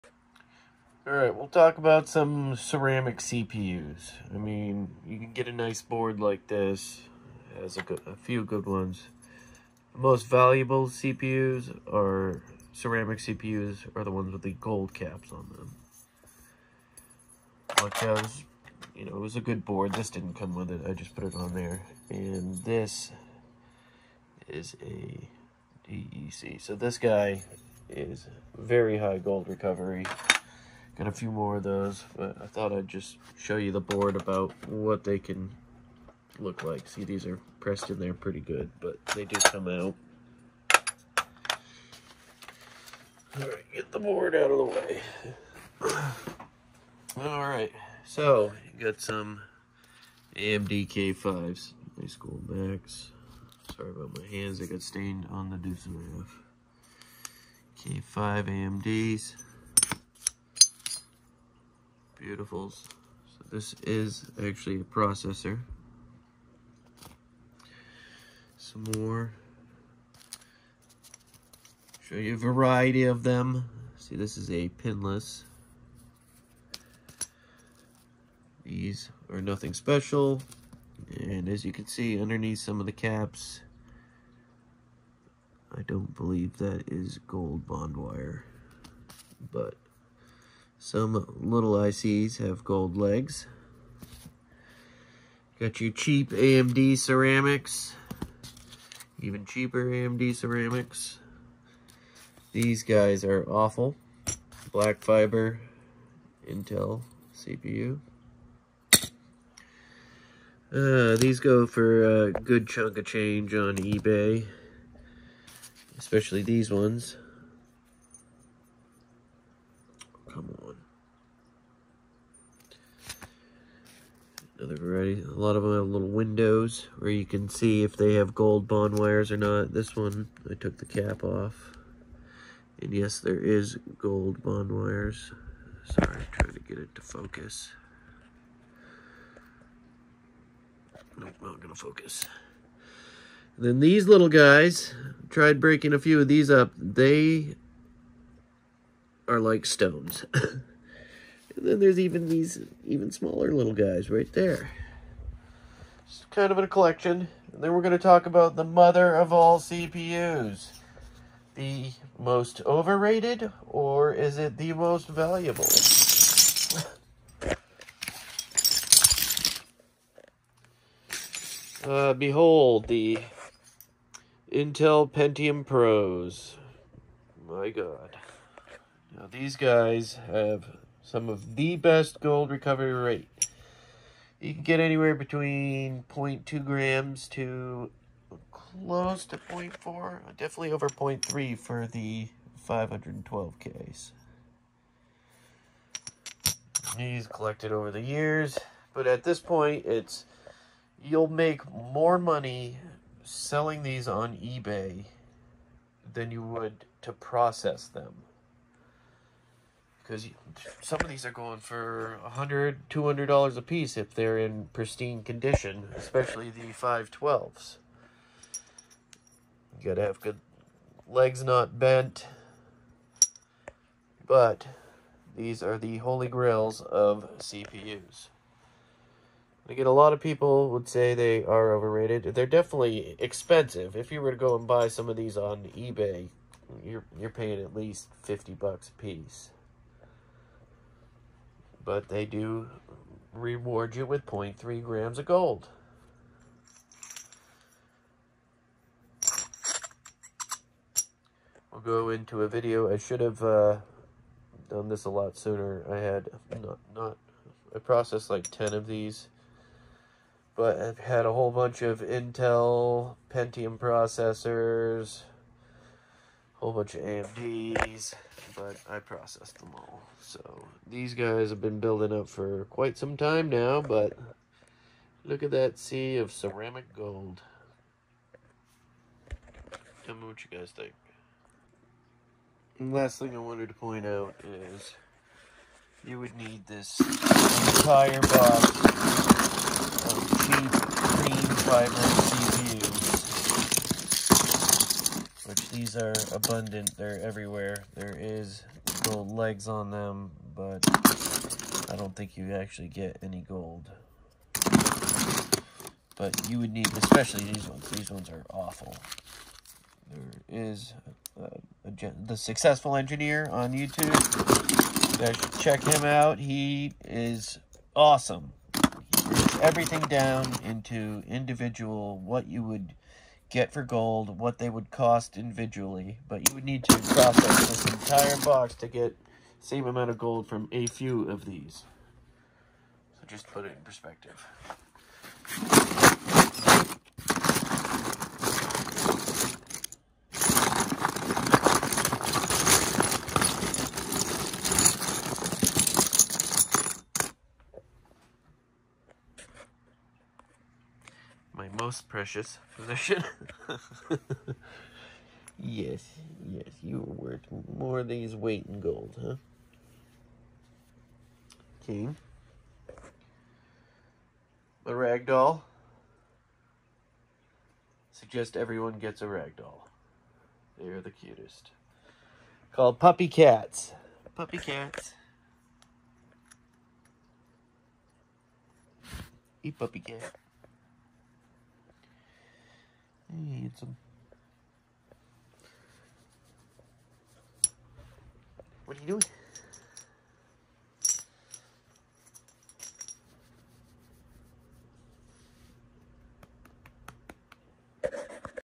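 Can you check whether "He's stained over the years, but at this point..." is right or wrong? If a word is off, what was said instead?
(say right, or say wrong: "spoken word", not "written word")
wrong: "collected", not "stained".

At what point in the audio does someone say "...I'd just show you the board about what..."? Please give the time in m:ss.
0:32.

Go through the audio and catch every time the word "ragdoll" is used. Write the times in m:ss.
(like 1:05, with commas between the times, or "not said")
6:04, 6:09.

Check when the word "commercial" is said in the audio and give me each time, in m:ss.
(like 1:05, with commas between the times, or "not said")
not said.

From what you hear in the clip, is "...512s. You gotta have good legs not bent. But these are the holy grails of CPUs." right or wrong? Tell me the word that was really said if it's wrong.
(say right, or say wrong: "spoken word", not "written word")
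right.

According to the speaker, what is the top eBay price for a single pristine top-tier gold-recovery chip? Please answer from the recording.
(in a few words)
$200.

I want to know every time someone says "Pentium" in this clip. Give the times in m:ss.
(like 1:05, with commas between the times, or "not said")
2:55, 4:23.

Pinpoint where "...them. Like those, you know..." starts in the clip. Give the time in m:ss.
0:15.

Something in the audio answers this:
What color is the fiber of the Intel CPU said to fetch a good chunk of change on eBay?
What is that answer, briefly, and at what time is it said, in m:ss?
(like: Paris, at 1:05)
Black, at 1:44.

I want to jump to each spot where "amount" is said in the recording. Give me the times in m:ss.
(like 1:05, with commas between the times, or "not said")
5:29.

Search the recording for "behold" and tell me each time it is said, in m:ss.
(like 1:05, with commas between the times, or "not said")
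2:52.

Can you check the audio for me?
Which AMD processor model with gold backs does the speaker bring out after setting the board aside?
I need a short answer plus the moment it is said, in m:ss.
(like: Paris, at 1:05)
K5, at 0:50.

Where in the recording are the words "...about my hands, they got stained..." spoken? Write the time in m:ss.
0:53.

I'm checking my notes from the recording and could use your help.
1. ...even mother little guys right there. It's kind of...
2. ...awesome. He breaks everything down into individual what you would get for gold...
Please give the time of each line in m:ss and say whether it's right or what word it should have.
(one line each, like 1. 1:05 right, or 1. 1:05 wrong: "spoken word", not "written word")
1. 2:32 wrong: "smaller", not "mother"
2. 5:17 right.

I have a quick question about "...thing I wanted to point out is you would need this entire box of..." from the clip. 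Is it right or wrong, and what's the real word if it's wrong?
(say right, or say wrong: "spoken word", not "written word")
right.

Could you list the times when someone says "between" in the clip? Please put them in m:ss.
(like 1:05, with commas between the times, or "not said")
3:05.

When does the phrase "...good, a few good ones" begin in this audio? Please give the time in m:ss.
0:07.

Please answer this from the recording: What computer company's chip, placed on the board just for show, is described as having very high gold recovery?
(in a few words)
DEC.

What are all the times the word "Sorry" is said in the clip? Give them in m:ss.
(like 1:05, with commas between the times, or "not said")
0:53, 2:15.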